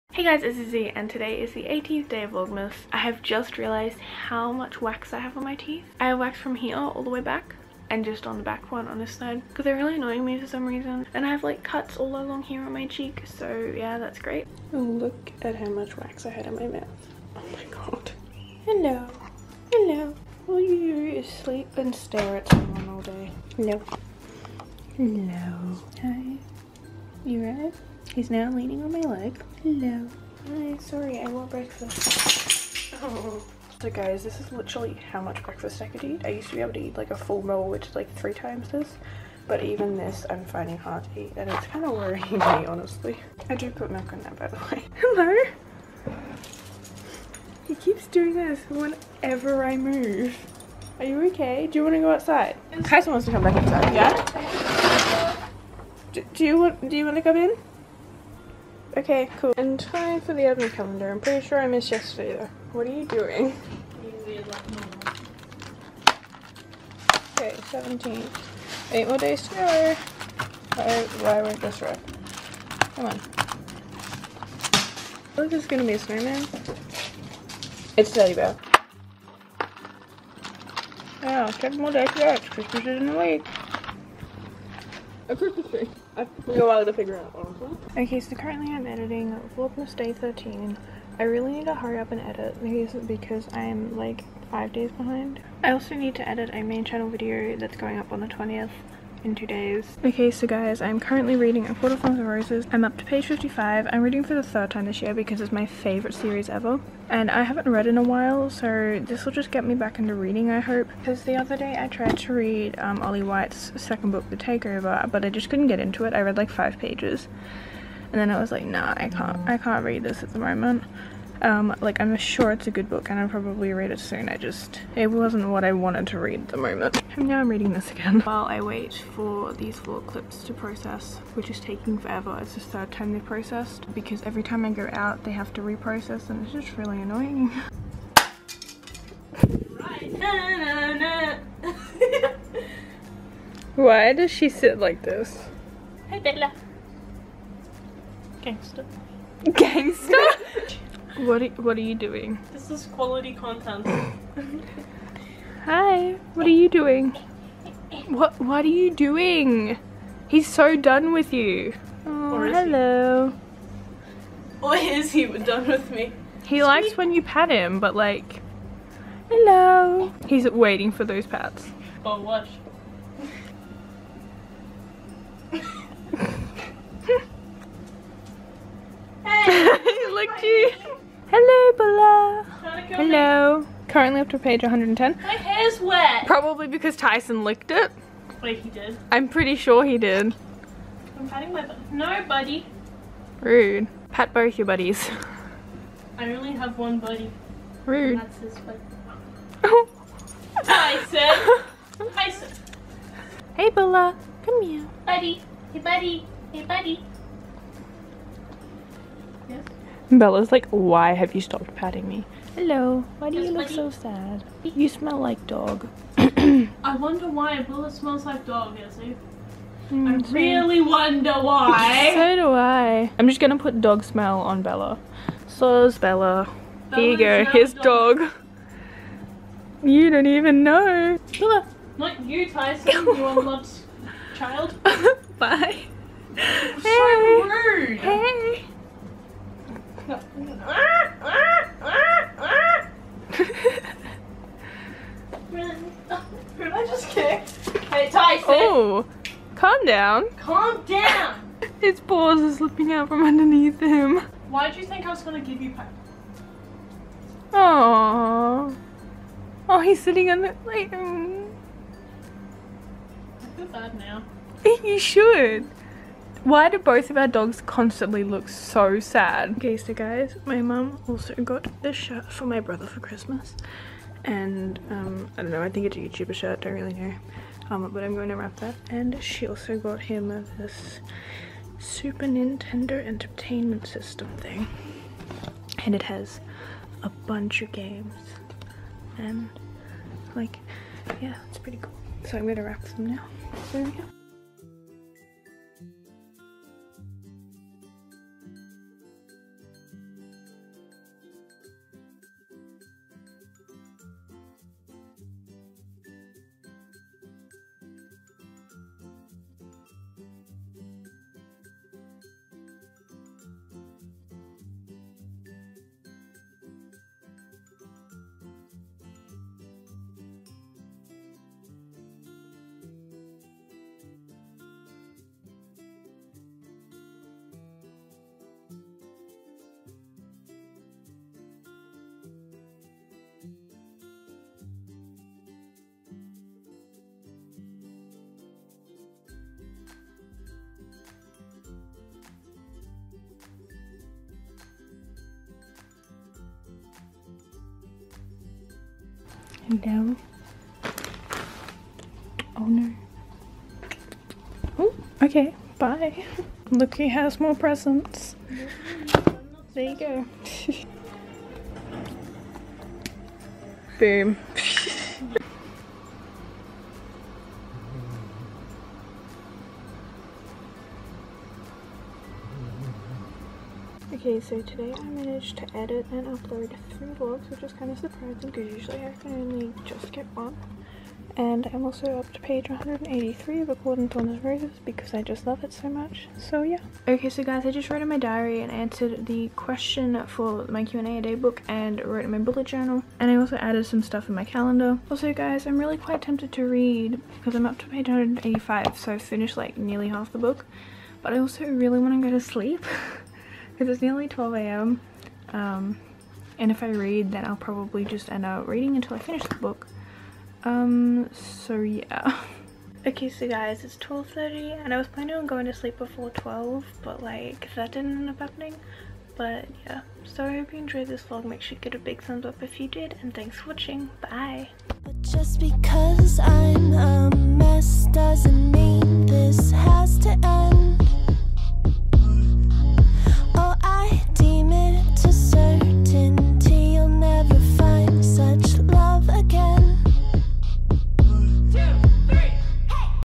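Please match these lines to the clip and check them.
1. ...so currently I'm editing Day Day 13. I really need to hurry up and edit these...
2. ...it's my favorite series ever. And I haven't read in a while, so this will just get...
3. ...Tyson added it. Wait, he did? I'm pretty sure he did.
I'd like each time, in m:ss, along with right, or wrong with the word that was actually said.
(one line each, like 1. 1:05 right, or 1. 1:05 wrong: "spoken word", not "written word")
1. 1:28 wrong: "Vlogmas", not "Day"
2. 1:45 right
3. 3:06 wrong: "licked", not "added".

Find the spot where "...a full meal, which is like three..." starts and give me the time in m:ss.
0:37.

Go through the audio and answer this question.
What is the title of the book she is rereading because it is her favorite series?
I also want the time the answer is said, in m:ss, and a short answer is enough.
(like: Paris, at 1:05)
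A Court of Thorns and Roses, at 1:41.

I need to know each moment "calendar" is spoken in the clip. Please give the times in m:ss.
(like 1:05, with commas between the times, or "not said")
1:00, 6:34.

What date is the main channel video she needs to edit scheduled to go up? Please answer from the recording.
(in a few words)
20th.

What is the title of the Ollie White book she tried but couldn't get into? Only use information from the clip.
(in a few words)
The Takeover.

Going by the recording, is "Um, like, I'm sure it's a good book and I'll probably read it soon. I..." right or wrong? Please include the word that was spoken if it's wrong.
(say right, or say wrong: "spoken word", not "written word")
right.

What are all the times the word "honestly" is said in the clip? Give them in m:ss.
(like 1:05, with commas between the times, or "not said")
0:42, 1:27.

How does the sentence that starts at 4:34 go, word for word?
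And, um, I don't know, I think it's a YouTuber shirt, don't really know um, but I'm going to wrap that.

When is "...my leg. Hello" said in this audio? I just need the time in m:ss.
0:28.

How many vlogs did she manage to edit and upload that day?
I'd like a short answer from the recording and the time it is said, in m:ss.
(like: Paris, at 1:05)
3, at 6:16.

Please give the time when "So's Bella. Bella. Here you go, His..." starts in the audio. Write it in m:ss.
3:45.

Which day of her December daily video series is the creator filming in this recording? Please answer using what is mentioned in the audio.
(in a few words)
18th.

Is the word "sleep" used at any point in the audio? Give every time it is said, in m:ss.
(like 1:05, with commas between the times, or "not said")
0:21, 6:42, 6:55.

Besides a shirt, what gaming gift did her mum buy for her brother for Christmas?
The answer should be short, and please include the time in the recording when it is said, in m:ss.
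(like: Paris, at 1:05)
Super Nintendo Entertainment System, at 4:41.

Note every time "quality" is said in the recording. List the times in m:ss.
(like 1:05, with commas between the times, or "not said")
2:32.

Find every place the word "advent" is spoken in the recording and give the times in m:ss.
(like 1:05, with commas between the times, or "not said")
1:00.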